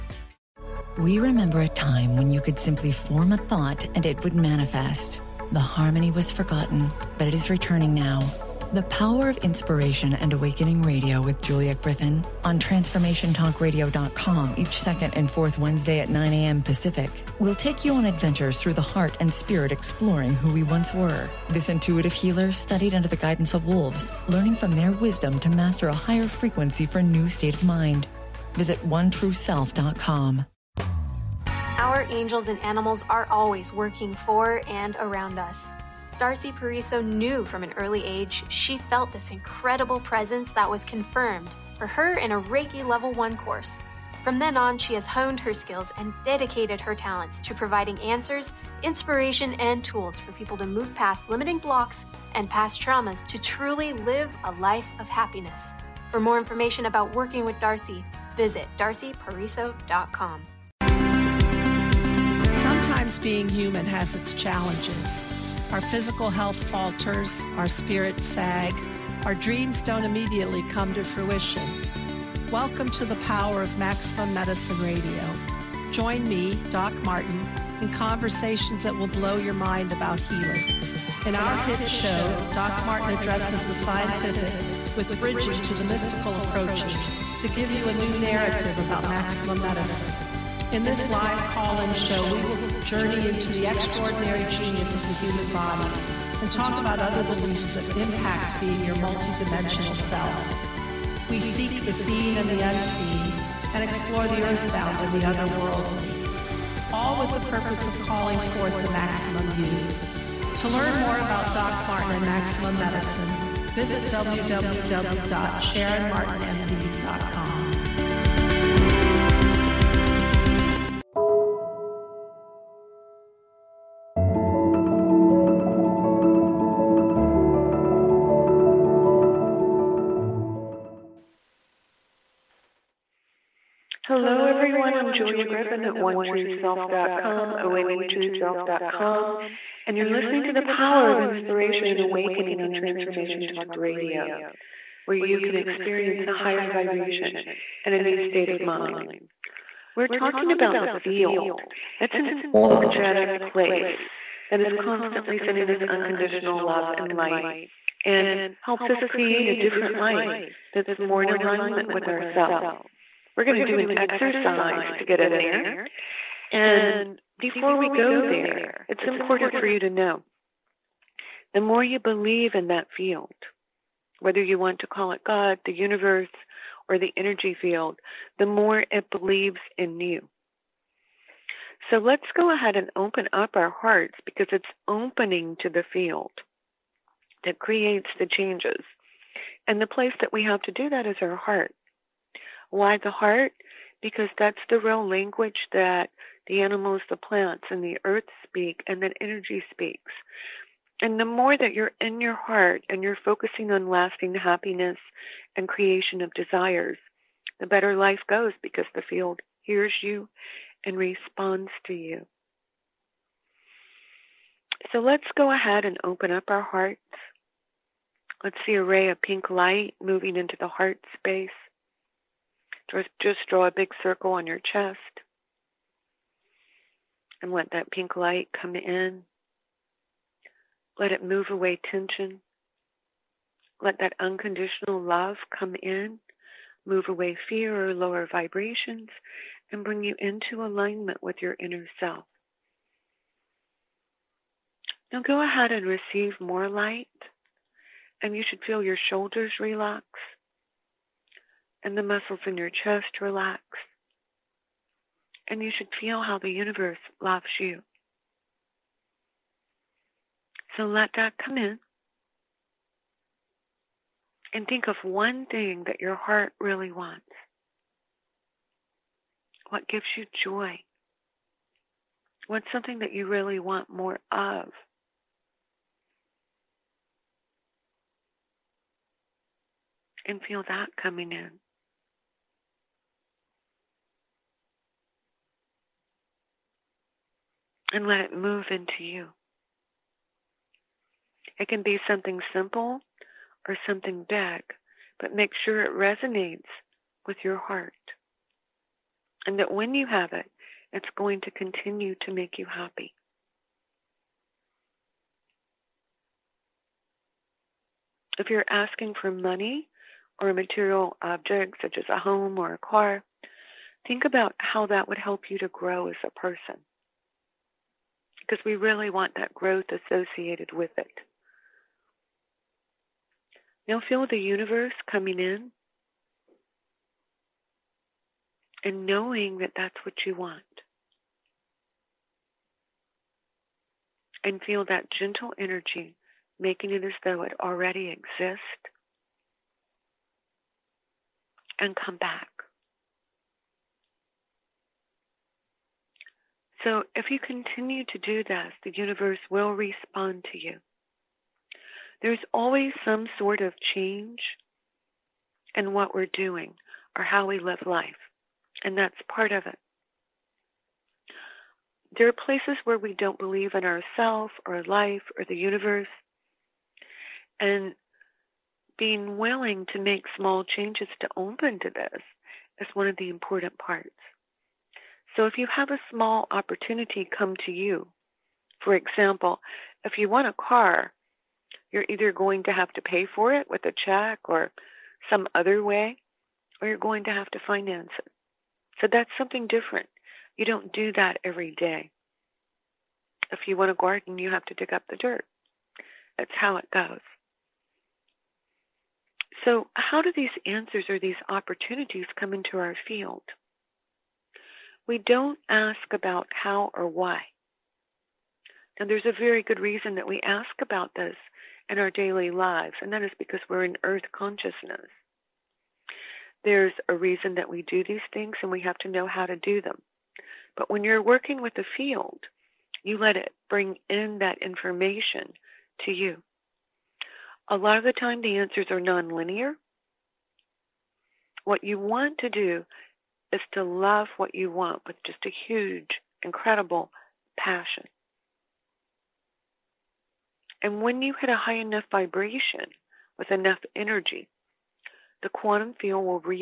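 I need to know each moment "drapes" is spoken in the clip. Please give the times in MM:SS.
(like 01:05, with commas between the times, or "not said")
not said.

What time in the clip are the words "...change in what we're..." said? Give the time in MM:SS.
05:53.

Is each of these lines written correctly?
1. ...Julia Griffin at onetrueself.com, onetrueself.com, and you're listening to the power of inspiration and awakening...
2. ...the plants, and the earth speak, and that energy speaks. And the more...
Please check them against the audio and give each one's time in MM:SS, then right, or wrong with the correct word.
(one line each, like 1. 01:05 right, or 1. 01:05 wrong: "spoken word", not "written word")
1. 02:15 right
2. 03:17 right.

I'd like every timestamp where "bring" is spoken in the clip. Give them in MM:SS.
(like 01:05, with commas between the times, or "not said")
03:59, 07:03.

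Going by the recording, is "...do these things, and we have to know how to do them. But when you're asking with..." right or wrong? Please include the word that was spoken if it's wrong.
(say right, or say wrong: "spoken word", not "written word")
wrong: "working", not "asking".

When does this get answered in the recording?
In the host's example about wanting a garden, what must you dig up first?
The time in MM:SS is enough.
06:35.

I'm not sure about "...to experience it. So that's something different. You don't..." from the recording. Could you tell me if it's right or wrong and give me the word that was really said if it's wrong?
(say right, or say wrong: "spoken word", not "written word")
wrong: "finance", not "experience".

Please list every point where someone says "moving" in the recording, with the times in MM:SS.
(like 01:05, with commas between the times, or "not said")
03:40.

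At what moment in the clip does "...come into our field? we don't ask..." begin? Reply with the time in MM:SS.
06:42.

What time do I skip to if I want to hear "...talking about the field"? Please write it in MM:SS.
02:30.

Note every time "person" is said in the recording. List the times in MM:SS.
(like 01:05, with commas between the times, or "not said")
05:16.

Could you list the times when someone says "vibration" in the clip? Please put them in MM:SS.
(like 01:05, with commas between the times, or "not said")
02:26, 03:58, 07:22.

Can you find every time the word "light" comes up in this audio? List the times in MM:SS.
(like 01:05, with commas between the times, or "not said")
02:37, 03:39, 03:48, 04:06.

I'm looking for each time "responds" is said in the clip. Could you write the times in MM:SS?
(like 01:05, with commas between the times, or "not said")
03:30, 05:49.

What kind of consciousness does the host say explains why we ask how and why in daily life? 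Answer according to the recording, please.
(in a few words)
Earth consciousness.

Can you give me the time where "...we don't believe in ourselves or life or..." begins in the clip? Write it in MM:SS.
06:02.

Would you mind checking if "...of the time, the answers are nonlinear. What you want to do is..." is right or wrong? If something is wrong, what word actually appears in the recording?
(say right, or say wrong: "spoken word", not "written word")
right.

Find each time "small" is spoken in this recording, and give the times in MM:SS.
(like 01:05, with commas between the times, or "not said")
06:10, 06:16.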